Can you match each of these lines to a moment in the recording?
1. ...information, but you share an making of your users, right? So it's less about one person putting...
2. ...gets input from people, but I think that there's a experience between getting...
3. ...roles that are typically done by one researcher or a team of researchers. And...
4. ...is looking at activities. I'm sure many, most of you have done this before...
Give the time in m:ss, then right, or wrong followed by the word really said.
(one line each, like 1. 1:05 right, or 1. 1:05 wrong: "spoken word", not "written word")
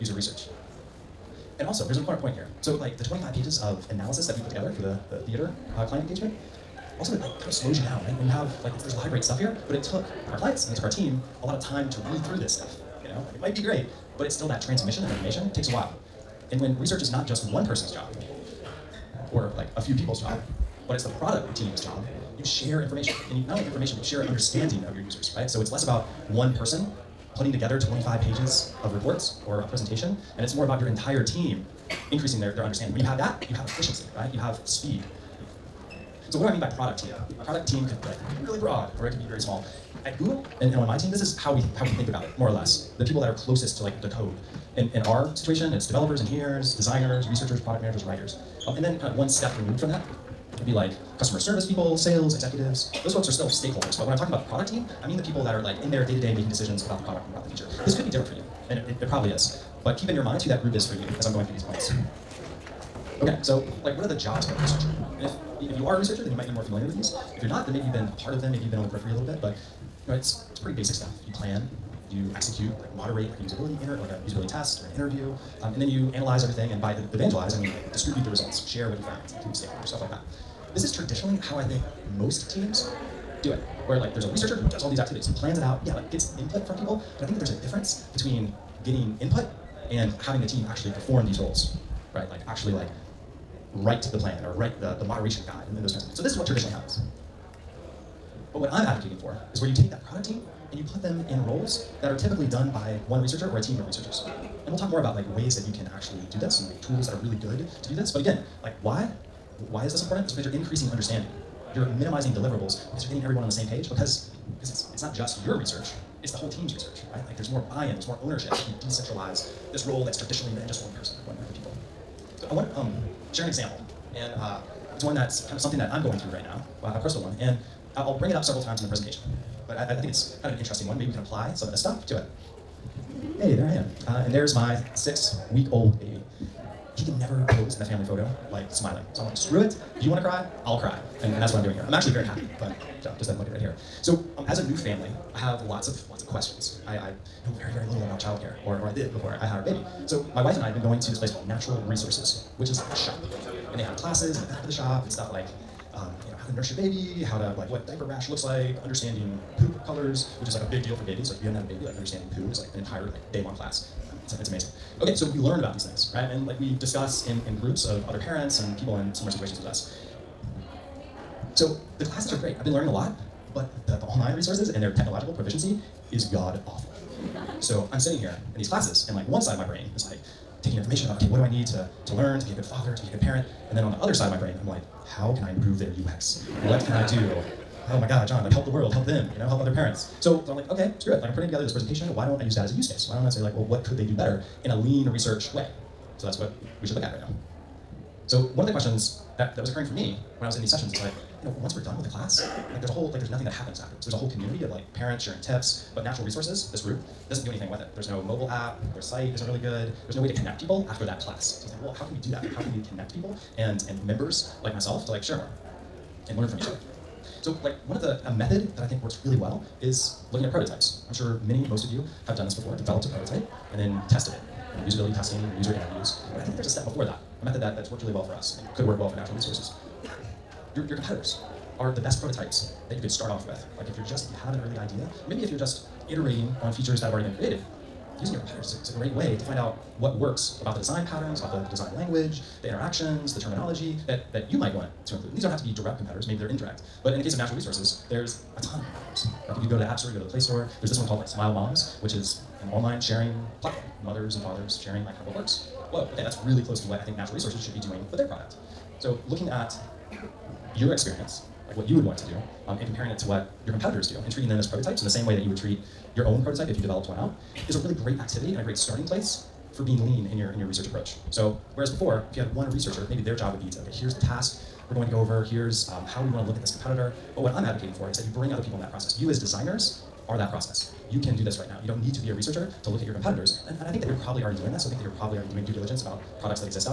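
1. 0:23 wrong: "understanding", not "making"
2. 1:26 wrong: "difference", not "experience"
3. 1:41 right
4. 3:39 wrong: "prototypes", not "activities".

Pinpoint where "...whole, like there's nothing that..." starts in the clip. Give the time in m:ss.
3:22.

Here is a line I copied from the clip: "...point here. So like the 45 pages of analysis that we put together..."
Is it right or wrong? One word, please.
wrong.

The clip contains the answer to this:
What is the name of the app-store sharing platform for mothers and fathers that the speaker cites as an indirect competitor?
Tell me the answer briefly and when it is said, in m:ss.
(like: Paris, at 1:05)
Smile Moms, at 4:11.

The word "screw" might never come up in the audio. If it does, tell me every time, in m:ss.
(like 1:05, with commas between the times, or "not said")
2:19, 3:10.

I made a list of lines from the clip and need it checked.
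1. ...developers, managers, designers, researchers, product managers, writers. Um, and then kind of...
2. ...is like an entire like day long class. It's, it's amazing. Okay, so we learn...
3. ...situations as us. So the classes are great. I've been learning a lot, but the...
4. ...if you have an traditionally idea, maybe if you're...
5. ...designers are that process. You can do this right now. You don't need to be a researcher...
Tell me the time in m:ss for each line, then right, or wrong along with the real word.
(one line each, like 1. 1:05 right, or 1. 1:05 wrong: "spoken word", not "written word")
1. 0:45 wrong: "engineers", not "managers"
2. 2:42 right
3. 2:49 right
4. 3:54 wrong: "early", not "traditionally"
5. 4:39 right.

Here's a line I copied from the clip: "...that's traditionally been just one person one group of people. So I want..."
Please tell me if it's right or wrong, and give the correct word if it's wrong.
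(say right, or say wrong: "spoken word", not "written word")
right.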